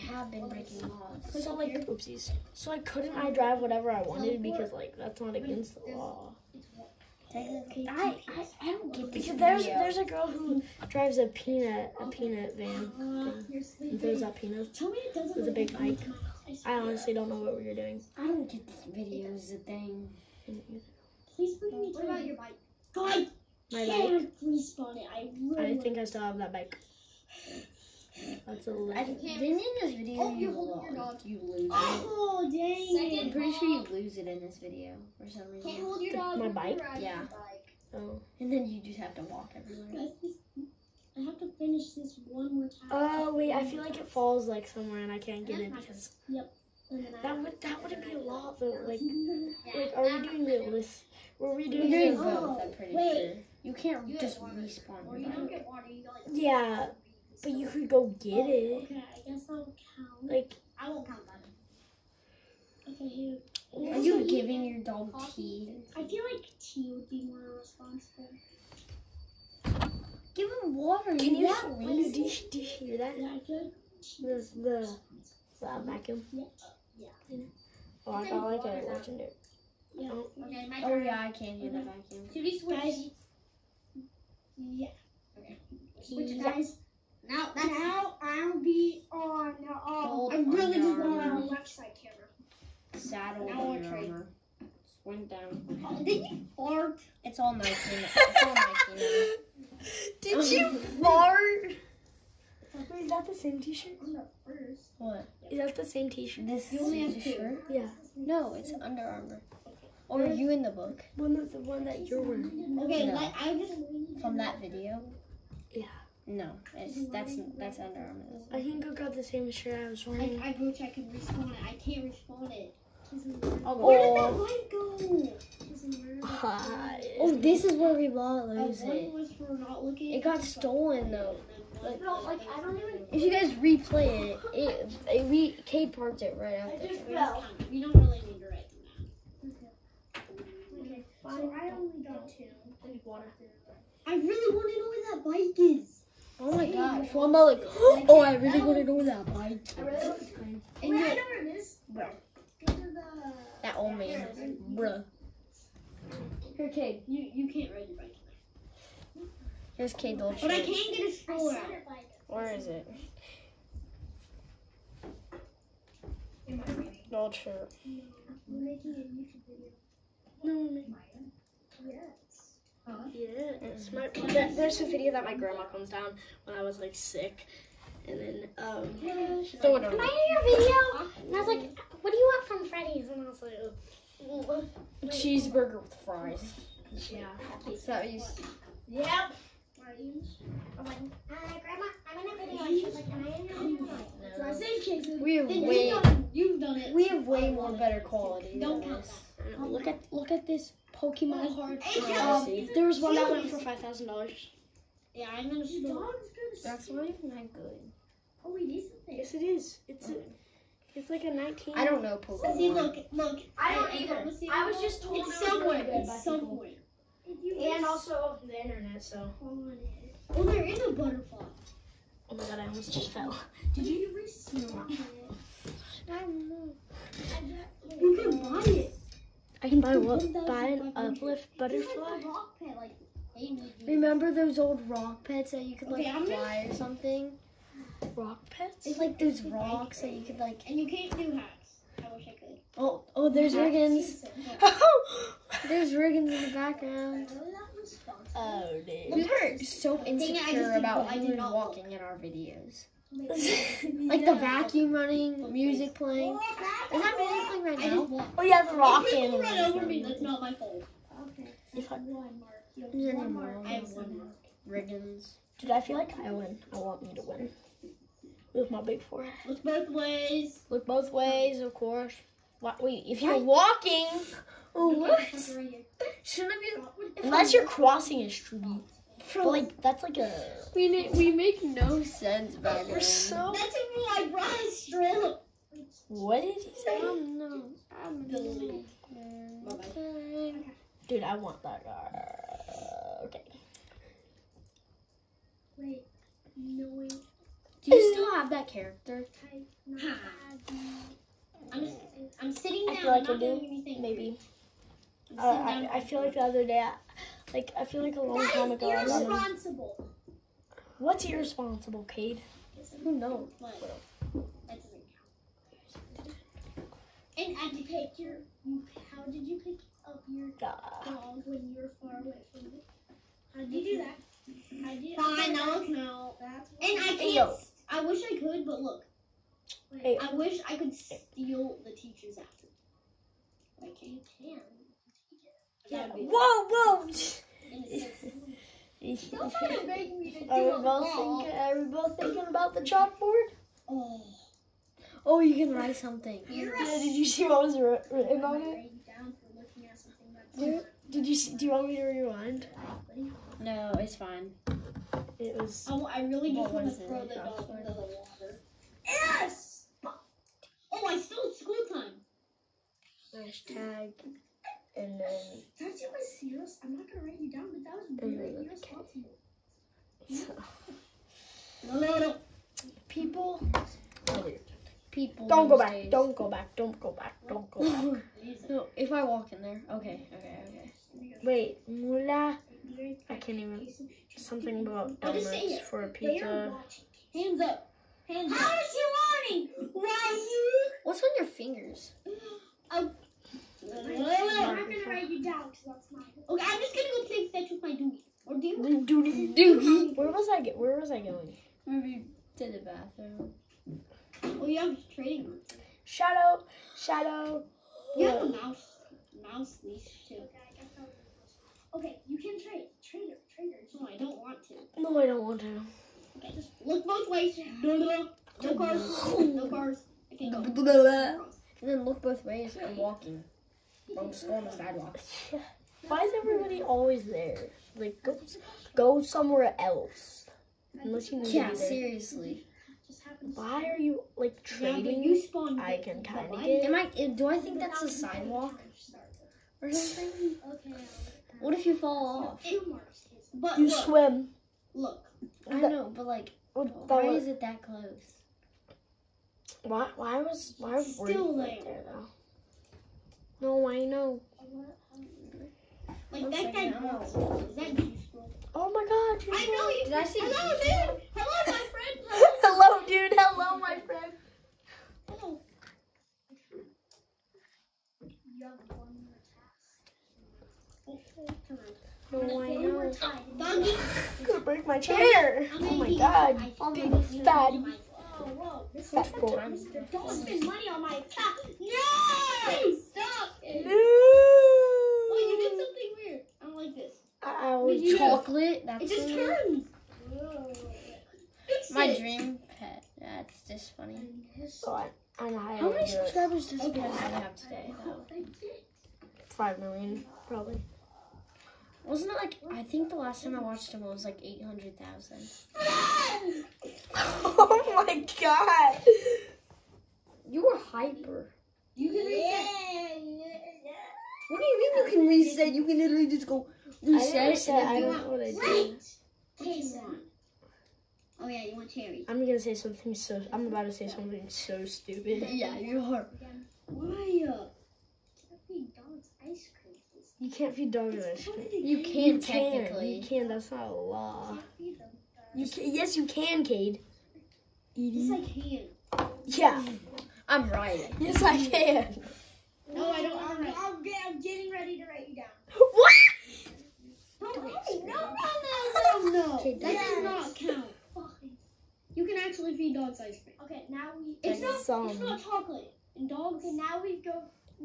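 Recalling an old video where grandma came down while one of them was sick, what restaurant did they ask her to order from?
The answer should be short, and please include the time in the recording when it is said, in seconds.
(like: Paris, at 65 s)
Freddy's, at 182 s.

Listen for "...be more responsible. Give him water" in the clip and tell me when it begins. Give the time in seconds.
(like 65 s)
67 s.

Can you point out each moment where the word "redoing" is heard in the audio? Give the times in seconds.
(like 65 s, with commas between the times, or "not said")
51 s.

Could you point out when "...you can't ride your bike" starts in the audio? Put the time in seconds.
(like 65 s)
157 s.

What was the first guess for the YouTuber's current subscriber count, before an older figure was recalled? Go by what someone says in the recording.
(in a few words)
5 million.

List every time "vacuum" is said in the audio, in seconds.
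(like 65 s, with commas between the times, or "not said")
75 s, 81 s, 254 s.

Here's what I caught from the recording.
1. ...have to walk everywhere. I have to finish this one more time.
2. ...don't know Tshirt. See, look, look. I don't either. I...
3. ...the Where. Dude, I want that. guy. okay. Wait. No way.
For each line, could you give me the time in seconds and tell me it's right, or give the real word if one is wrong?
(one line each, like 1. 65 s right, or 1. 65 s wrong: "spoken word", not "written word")
1. 38 s right
2. 211 s wrong: "Pokemon", not "Tshirt"
3. 288 s wrong: "Okay", not "Where".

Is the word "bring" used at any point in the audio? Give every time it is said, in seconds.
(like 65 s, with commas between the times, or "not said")
21 s.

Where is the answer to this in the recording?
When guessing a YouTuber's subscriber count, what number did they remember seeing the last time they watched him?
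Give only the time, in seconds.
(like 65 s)
504 s.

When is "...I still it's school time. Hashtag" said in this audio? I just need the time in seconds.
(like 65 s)
361 s.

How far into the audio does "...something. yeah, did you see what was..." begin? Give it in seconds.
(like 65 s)
345 s.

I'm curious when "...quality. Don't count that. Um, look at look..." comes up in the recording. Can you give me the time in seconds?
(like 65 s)
198 s.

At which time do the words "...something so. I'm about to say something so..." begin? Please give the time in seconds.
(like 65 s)
522 s.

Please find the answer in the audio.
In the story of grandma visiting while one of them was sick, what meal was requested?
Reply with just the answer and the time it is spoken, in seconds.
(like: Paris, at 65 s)
Cheeseburger with fries, at 185 s.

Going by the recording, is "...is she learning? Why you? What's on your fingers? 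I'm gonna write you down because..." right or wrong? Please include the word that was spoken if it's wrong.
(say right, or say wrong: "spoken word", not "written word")
right.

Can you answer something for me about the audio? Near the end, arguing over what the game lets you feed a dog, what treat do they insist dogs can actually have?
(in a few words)
ice cream.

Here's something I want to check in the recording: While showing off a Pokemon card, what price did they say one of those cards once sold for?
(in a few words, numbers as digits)
$5,000.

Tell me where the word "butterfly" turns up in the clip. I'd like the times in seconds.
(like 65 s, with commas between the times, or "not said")
220 s, 231 s.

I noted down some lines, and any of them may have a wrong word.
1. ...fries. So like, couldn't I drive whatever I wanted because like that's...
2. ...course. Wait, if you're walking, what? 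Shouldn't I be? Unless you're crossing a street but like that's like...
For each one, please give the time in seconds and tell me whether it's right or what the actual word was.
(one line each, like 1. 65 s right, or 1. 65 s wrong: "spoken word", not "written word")
1. 1 s wrong: "oopsies", not "fries"
2. 271 s right.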